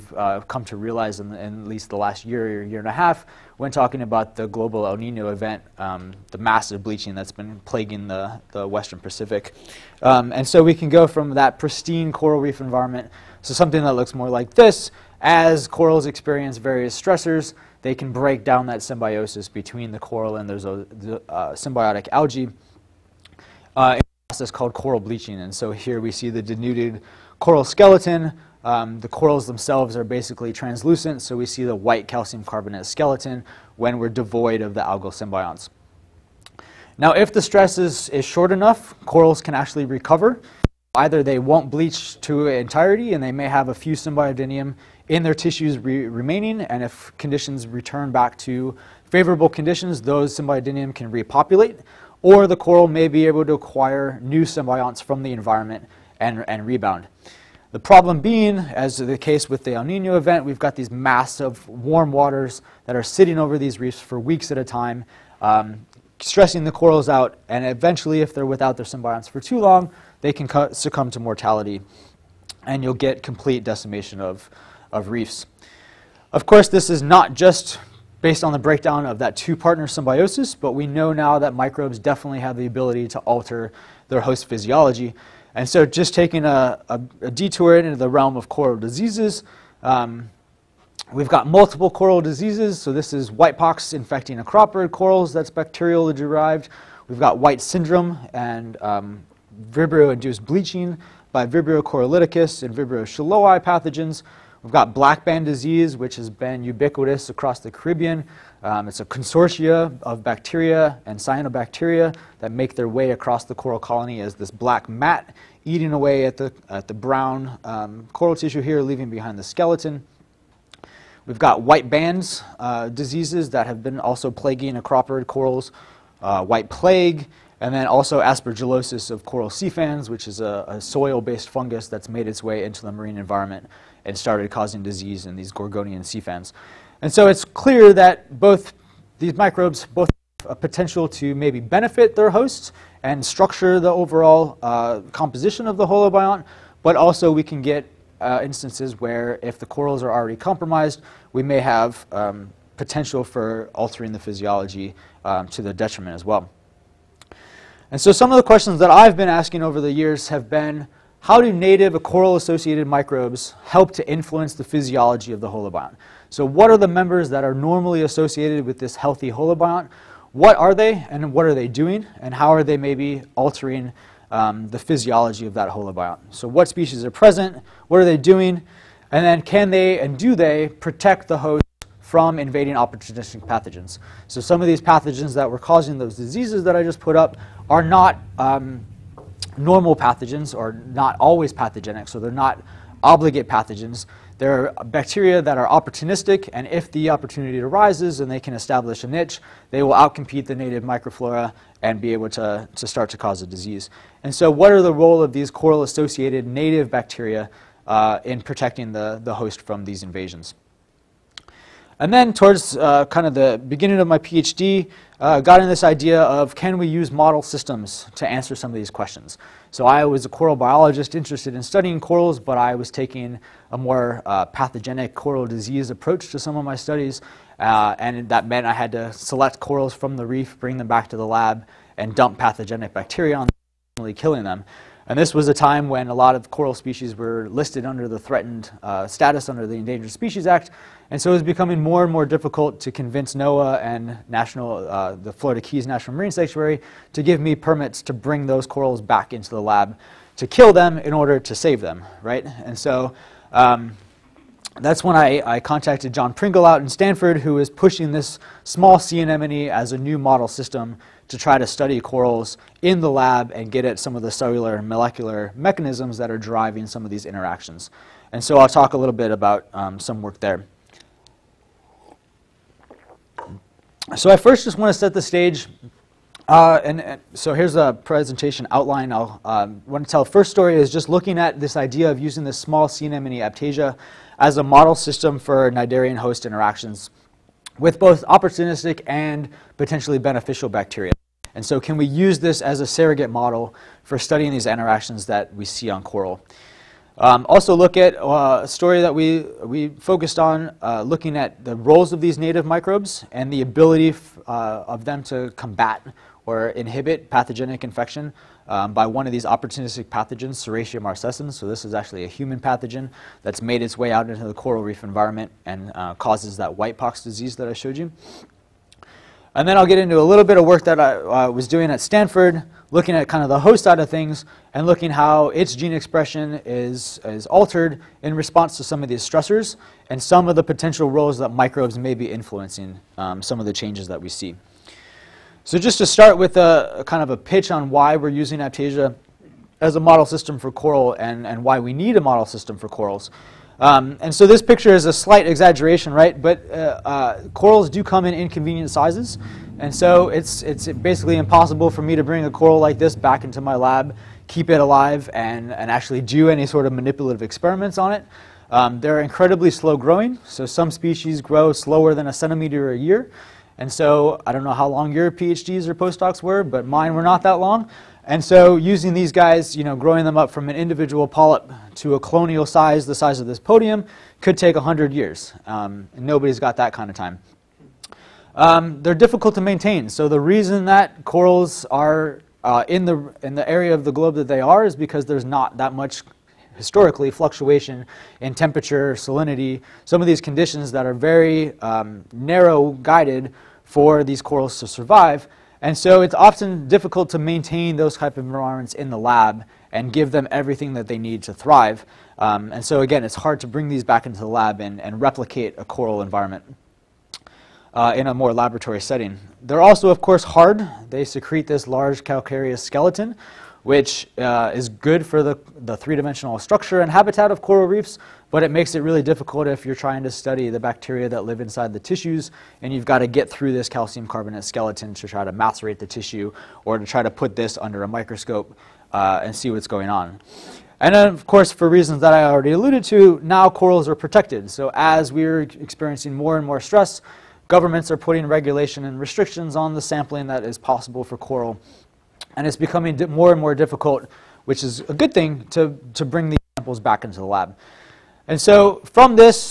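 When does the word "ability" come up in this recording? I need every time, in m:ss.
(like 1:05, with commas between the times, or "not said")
1:22, 5:03.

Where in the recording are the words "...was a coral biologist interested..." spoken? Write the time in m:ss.
3:40.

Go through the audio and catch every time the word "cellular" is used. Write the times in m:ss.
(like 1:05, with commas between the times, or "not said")
4:24.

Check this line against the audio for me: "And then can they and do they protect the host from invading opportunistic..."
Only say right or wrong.
right.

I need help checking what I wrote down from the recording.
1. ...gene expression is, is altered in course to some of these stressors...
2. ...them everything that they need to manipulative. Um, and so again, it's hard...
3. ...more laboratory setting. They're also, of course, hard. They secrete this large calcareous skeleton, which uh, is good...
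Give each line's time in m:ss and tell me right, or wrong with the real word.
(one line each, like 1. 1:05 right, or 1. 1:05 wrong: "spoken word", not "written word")
1. 5:25 wrong: "response", not "course"
2. 6:40 wrong: "thrive", not "manipulative"
3. 6:48 right.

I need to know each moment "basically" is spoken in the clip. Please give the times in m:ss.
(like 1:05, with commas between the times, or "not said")
0:30, 5:50.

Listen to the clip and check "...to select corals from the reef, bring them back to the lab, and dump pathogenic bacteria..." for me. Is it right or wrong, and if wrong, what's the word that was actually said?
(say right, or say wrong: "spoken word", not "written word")
right.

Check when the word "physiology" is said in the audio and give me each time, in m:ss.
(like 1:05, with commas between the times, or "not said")
1:24, 2:34, 2:44, 2:54.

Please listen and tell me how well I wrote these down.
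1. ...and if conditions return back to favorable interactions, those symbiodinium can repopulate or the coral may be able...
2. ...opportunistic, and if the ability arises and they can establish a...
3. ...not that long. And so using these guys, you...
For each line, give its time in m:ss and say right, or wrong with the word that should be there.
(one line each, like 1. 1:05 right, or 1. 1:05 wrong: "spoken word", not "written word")
1. 0:46 wrong: "conditions", not "interactions"
2. 3:15 wrong: "opportunity", not "ability"
3. 6:07 right.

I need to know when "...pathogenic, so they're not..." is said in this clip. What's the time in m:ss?
3:11.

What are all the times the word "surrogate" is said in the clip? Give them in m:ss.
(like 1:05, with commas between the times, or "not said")
4:52.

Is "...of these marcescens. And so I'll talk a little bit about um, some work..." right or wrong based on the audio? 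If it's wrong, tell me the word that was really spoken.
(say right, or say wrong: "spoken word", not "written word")
wrong: "interactions", not "marcescens".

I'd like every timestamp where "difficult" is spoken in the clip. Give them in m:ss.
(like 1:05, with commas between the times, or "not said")
4:02, 6:19, 6:36, 6:59, 7:23.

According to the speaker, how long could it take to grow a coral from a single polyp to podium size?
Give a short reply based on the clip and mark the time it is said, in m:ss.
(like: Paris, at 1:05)
100 years, at 6:14.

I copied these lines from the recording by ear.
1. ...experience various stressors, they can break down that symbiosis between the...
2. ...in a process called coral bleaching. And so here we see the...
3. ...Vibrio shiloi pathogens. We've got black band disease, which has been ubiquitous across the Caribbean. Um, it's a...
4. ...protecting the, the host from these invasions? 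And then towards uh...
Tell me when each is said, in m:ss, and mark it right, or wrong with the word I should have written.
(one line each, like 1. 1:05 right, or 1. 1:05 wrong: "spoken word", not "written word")
1. 0:16 right
2. 0:23 right
3. 1:42 right
4. 3:28 right.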